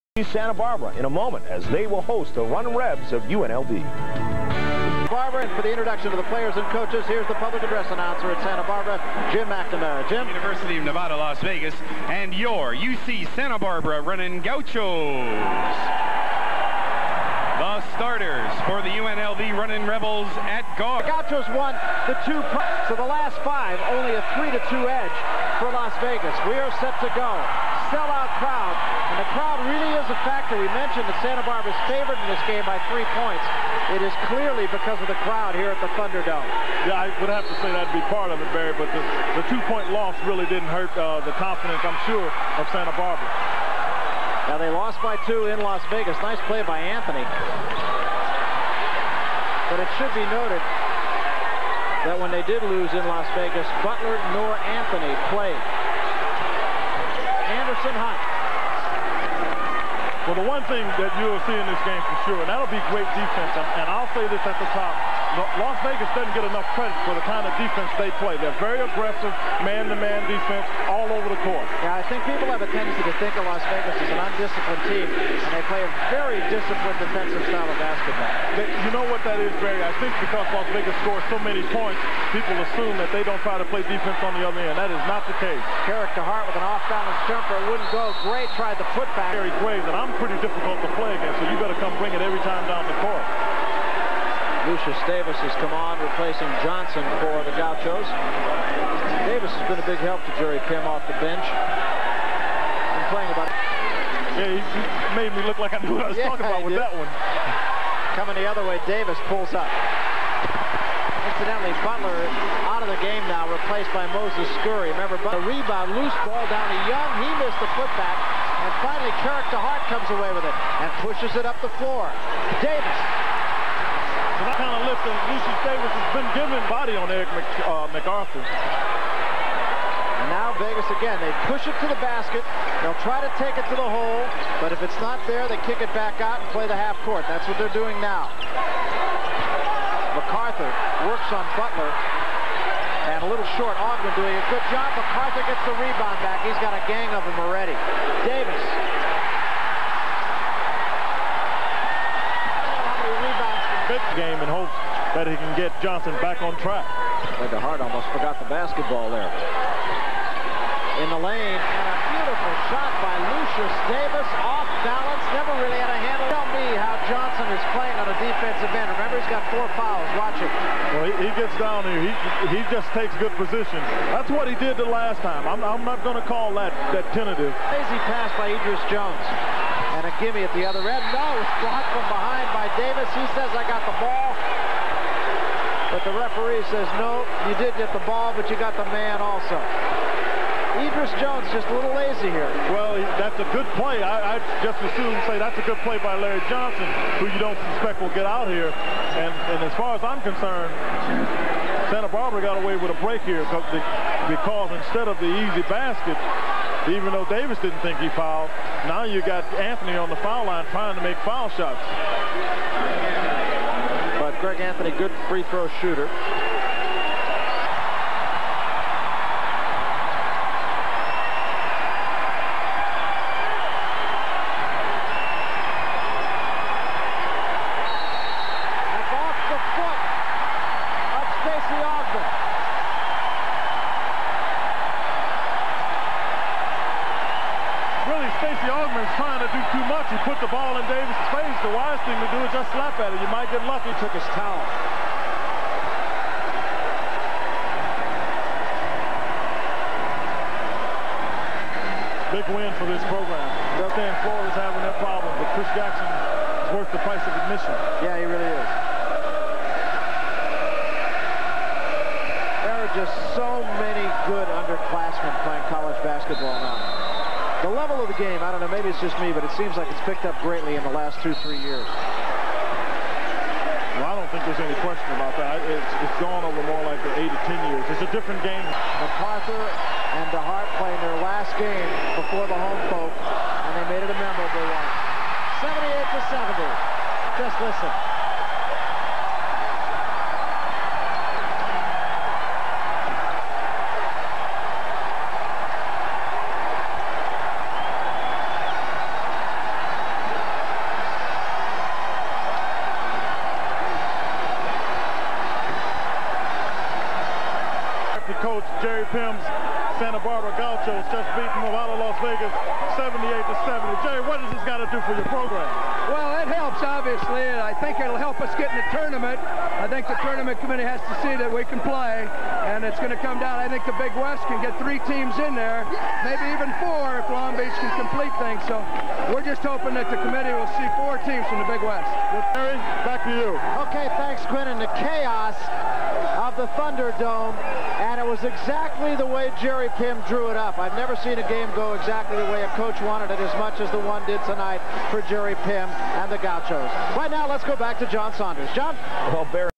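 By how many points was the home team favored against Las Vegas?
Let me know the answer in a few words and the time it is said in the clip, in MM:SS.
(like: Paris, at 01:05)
3, at 00:32.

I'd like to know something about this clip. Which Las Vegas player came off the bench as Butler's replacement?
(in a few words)
Moses Scurry.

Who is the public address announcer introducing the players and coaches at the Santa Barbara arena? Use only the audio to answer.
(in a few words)
Jim McNamara.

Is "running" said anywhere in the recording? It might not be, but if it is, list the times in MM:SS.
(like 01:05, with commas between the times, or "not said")
00:14, 00:19.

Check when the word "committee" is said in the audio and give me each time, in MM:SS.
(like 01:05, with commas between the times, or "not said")
05:20, 05:30.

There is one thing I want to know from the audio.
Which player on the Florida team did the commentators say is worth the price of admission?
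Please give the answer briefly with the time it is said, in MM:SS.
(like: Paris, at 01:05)
Chris Jackson, at 04:15.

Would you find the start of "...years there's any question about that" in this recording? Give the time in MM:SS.
04:31.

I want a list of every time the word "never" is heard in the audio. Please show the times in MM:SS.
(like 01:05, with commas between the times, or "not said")
02:45, 05:40.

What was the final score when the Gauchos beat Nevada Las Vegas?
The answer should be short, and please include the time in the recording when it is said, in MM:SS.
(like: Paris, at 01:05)
78 to 70, at 05:12.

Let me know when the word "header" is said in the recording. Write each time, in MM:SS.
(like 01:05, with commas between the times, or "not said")
not said.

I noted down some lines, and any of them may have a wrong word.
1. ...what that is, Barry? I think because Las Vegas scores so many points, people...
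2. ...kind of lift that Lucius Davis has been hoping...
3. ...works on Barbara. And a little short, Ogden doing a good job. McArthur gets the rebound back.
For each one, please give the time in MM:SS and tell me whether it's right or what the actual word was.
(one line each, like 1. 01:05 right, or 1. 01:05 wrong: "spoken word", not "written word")
1. 01:19 right
2. 02:04 wrong: "giving", not "hoping"
3. 02:21 wrong: "Butler", not "Barbara".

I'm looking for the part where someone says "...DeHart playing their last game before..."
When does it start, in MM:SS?
04:40.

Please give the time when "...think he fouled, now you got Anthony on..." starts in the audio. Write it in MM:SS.
03:27.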